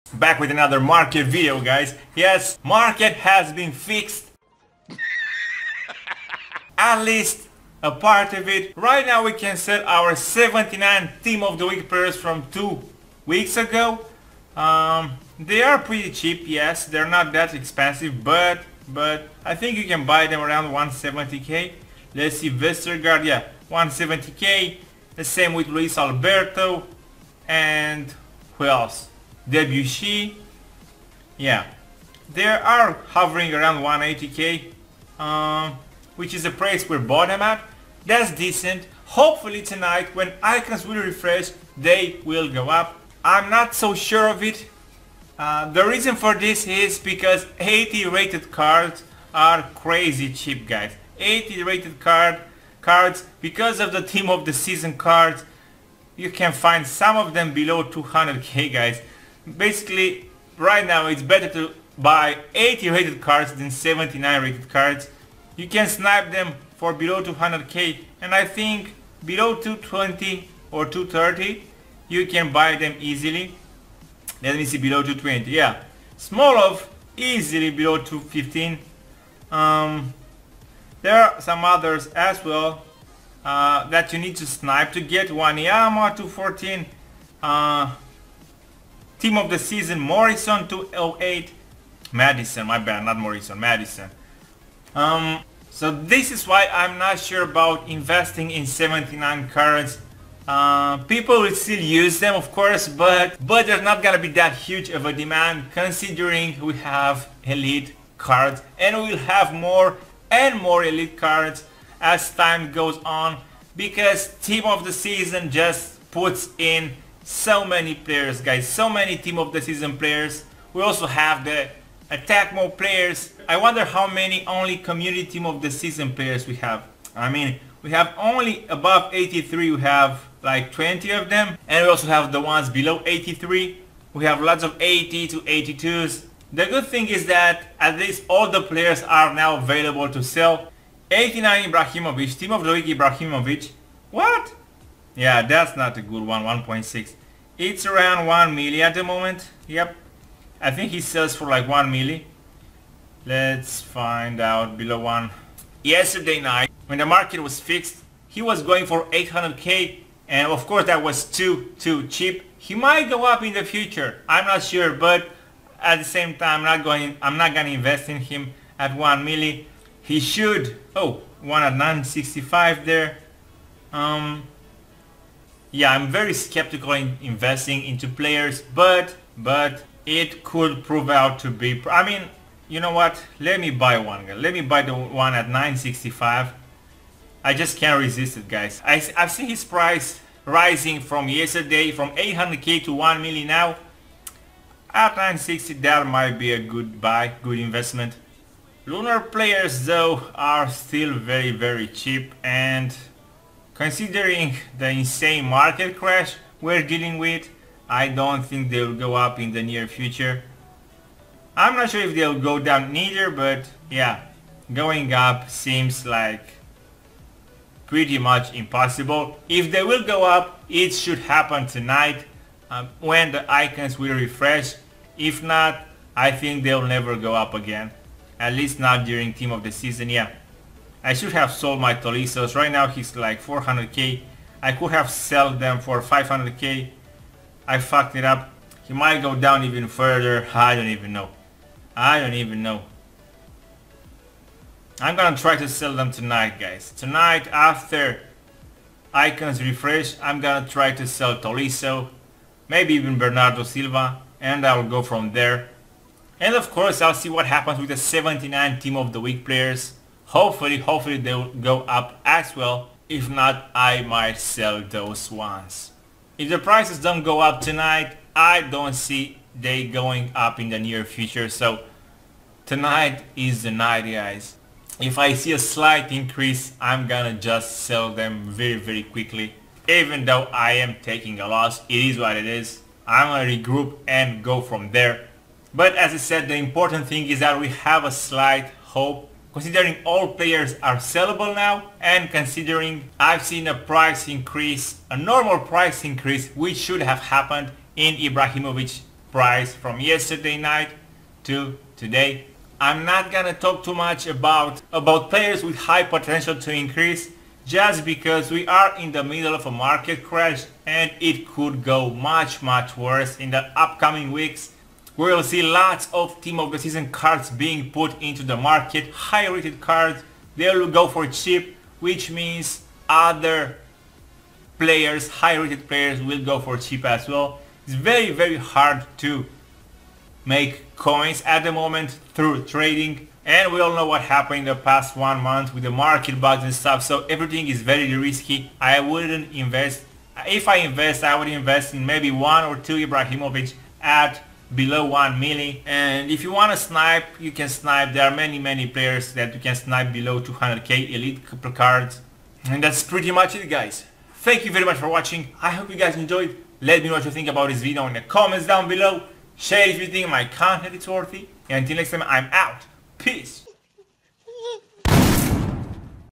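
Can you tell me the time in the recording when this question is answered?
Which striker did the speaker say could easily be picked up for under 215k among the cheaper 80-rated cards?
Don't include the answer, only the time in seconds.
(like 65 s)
76 s.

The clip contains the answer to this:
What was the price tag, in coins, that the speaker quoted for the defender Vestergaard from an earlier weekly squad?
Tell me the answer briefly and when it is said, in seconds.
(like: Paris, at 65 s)
170k, at 23 s.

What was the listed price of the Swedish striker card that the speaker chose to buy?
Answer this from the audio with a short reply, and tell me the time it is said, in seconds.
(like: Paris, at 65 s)
965k, at 171 s.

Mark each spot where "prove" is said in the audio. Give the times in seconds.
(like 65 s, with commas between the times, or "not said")
180 s.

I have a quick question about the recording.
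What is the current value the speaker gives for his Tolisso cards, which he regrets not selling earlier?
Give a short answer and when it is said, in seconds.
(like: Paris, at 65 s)
400k, at 232 s.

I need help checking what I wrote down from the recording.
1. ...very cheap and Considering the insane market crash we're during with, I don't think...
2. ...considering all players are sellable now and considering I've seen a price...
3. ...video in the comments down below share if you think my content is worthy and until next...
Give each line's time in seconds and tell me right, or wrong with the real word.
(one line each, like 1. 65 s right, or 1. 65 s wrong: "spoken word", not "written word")
1. 201 s wrong: "dealing", not "during"
2. 289 s right
3. 357 s right.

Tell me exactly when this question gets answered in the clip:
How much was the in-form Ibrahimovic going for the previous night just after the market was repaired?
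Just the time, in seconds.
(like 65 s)
158 s.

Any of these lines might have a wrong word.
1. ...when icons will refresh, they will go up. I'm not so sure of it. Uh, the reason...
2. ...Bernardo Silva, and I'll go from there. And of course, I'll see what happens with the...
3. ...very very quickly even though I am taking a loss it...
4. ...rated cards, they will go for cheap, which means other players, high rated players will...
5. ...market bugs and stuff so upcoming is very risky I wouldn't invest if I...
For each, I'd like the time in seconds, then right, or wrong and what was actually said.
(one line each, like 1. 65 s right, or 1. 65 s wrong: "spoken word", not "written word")
1. 40 s right
2. 253 s right
3. 278 s right
4. 319 s right
5. 335 s wrong: "everything", not "upcoming".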